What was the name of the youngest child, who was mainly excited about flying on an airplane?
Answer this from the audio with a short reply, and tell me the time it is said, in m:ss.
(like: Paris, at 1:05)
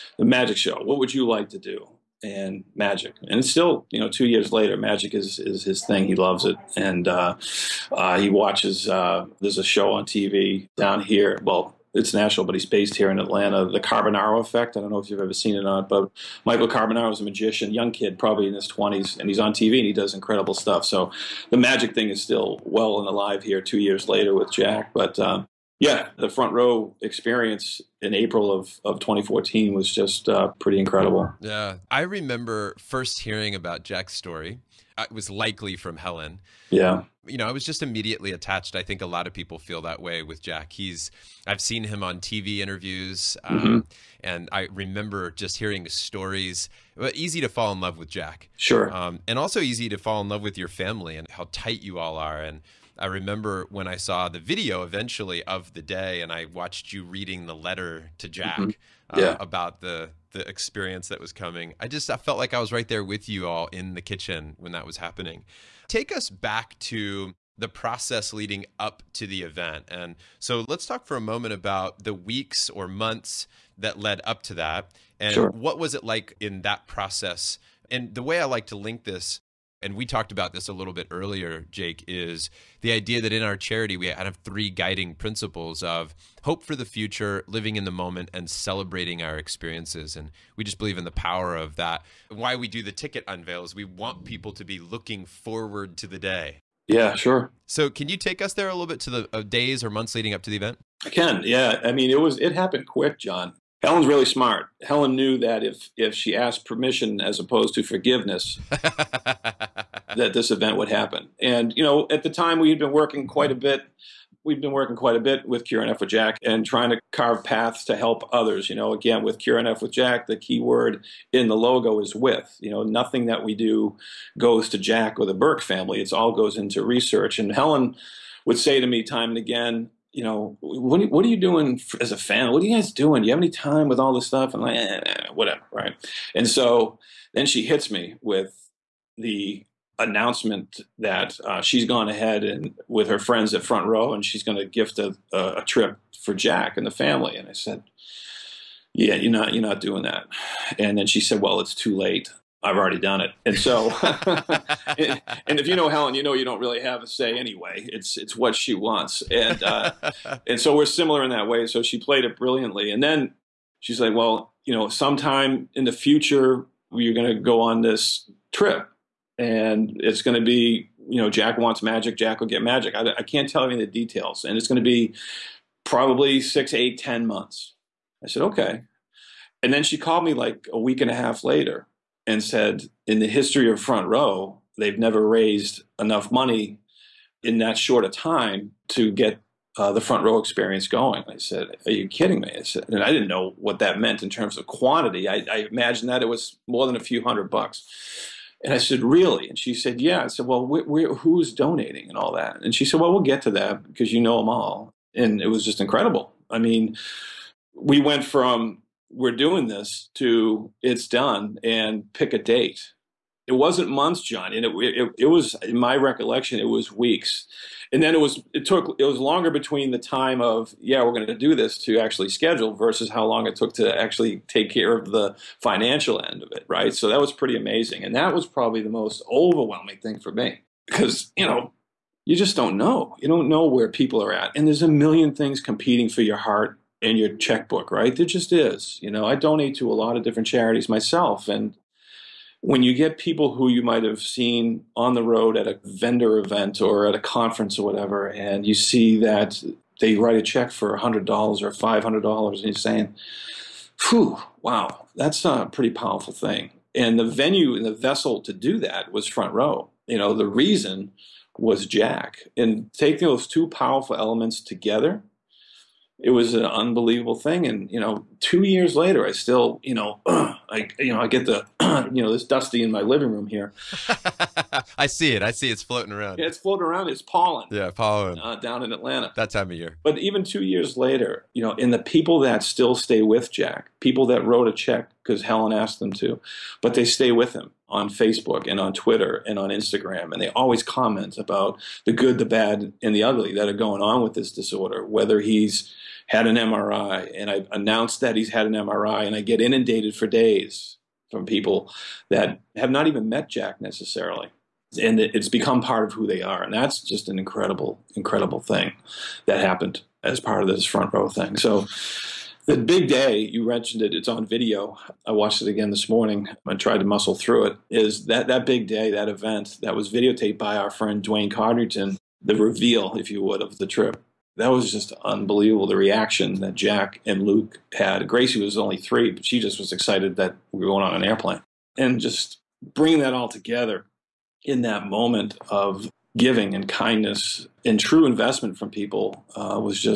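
Gracie, at 5:28.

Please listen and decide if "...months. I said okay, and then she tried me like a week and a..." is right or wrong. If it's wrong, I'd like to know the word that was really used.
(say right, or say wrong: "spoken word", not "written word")
wrong: "called", not "tried".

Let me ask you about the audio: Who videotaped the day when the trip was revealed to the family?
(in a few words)
Dwayne Codrington.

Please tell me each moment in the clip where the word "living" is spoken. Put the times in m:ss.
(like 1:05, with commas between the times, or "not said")
1:27, 4:33.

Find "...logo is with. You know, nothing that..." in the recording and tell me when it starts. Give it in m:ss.
2:01.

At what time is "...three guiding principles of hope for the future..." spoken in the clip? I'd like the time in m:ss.
1:24.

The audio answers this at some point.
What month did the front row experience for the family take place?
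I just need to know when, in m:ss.
0:28.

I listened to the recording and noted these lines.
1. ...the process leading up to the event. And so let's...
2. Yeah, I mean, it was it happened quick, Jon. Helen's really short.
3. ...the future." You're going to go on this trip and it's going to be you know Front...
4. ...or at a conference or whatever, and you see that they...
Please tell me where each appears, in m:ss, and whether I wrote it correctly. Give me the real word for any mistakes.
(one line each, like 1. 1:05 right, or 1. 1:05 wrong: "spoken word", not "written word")
1. 1:07 right
2. 1:41 wrong: "smart", not "short"
3. 2:45 wrong: "Jack", not "Front"
4. 4:06 right.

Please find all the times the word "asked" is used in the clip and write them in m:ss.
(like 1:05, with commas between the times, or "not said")
1:46, 4:45.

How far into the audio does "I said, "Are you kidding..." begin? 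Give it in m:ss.
3:11.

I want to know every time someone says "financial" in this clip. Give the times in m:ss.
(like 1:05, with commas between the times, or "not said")
3:45.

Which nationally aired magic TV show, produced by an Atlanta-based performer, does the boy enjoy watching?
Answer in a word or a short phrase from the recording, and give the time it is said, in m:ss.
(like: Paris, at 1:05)
The Carbonaro Effect, at 0:13.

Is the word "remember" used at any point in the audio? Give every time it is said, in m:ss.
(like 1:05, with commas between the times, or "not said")
0:32, 0:44, 0:53.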